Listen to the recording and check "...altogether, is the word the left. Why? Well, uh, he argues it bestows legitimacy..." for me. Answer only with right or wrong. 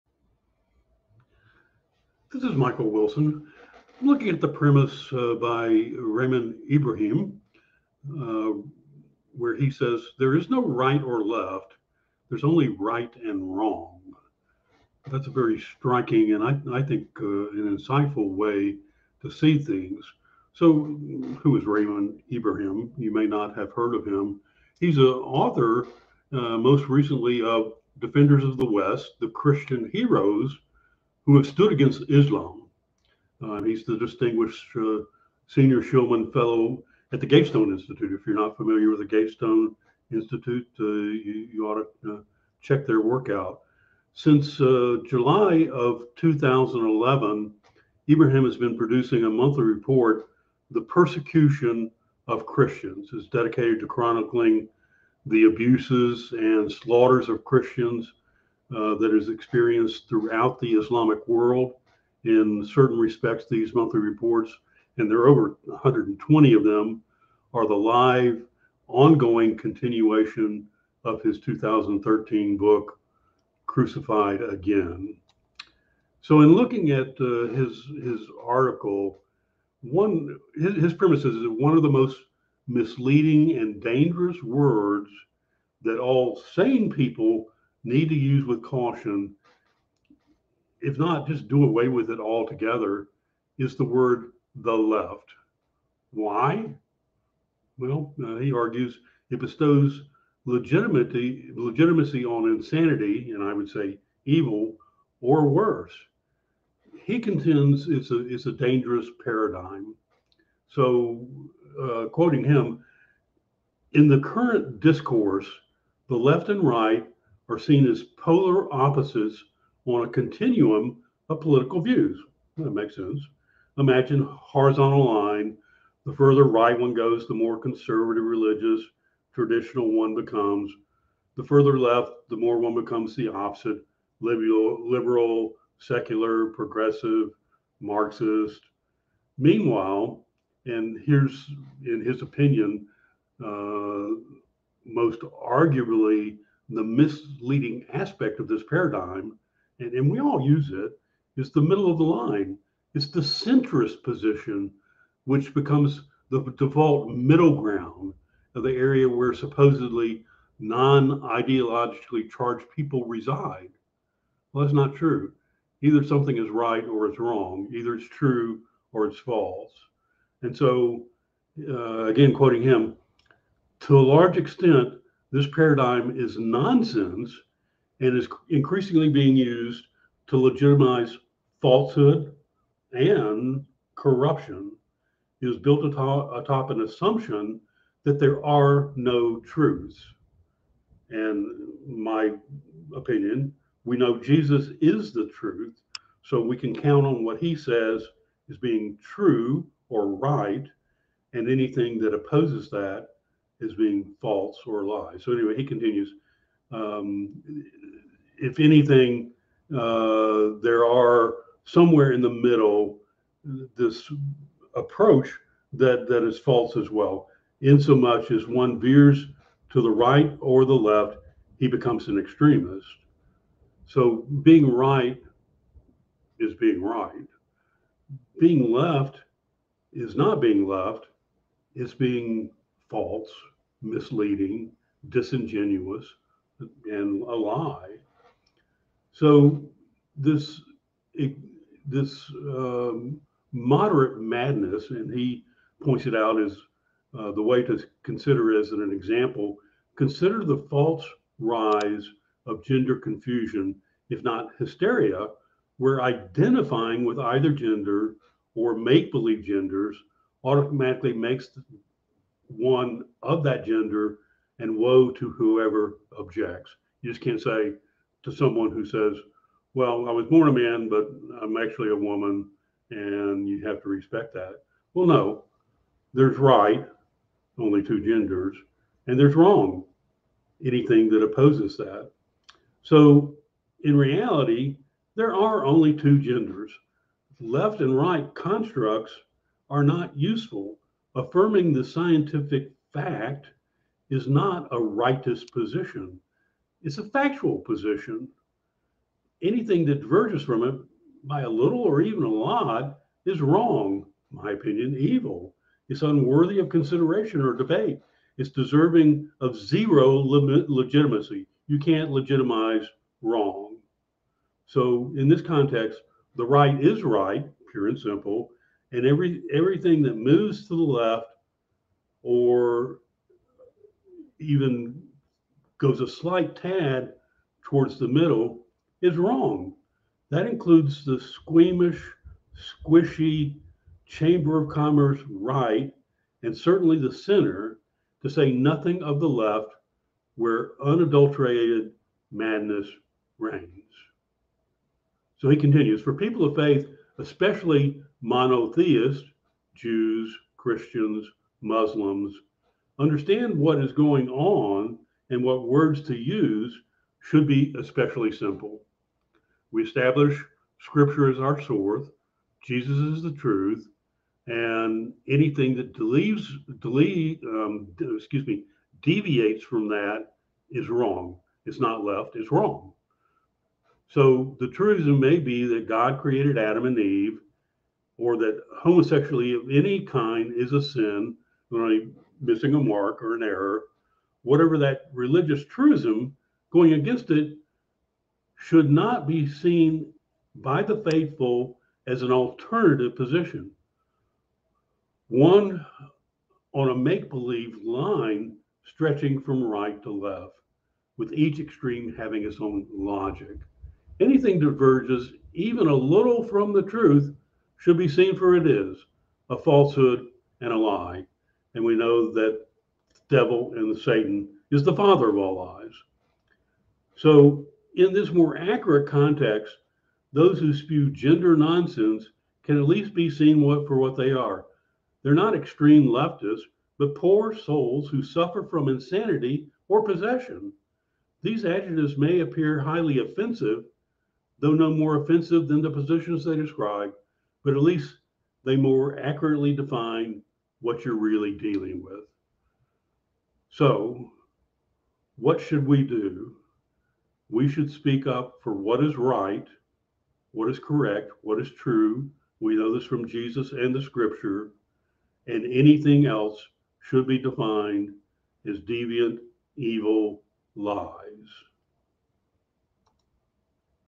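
right.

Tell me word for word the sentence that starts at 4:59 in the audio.
Anything that diverges from it by a little or even a lot is wrong, my opinion, evil.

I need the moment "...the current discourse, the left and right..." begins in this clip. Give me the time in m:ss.
1:54.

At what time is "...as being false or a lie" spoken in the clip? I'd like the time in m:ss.
3:23.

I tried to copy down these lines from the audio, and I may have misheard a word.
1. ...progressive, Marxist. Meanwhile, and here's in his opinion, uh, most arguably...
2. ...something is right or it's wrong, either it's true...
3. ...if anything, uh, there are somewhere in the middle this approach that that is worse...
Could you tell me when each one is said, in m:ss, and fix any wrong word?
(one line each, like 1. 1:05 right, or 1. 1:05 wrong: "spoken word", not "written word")
1. 2:16 right
2. 2:46 right
3. 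3:28 wrong: "false", not "worse".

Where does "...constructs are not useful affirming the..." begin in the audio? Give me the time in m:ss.
4:48.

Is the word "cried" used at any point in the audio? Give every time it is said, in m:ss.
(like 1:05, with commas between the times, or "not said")
not said.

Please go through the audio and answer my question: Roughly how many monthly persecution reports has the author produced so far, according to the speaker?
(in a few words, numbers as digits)
over 120.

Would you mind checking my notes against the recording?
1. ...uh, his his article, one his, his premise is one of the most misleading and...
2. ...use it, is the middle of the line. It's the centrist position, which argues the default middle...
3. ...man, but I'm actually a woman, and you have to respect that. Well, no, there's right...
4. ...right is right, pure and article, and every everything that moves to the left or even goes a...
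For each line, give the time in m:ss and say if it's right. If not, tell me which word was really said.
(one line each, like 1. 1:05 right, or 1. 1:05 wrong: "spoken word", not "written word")
1. 1:17 right
2. 2:30 wrong: "becomes", not "argues"
3. 4:30 right
4. 5:16 wrong: "simple", not "article".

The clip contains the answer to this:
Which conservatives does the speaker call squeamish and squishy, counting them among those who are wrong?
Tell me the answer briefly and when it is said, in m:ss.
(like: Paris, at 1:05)
Chamber of Commerce right, at 5:34.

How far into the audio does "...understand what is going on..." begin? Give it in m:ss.
5:52.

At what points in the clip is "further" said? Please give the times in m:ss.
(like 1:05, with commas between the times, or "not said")
2:06, 2:11.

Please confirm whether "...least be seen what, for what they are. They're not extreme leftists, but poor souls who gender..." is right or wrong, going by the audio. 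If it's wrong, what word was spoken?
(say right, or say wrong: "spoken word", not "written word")
wrong: "suffer", not "gender".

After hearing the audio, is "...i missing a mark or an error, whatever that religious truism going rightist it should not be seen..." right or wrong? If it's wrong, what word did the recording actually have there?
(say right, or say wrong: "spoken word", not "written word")
wrong: "against", not "rightist".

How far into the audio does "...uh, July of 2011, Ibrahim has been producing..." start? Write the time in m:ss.
0:44.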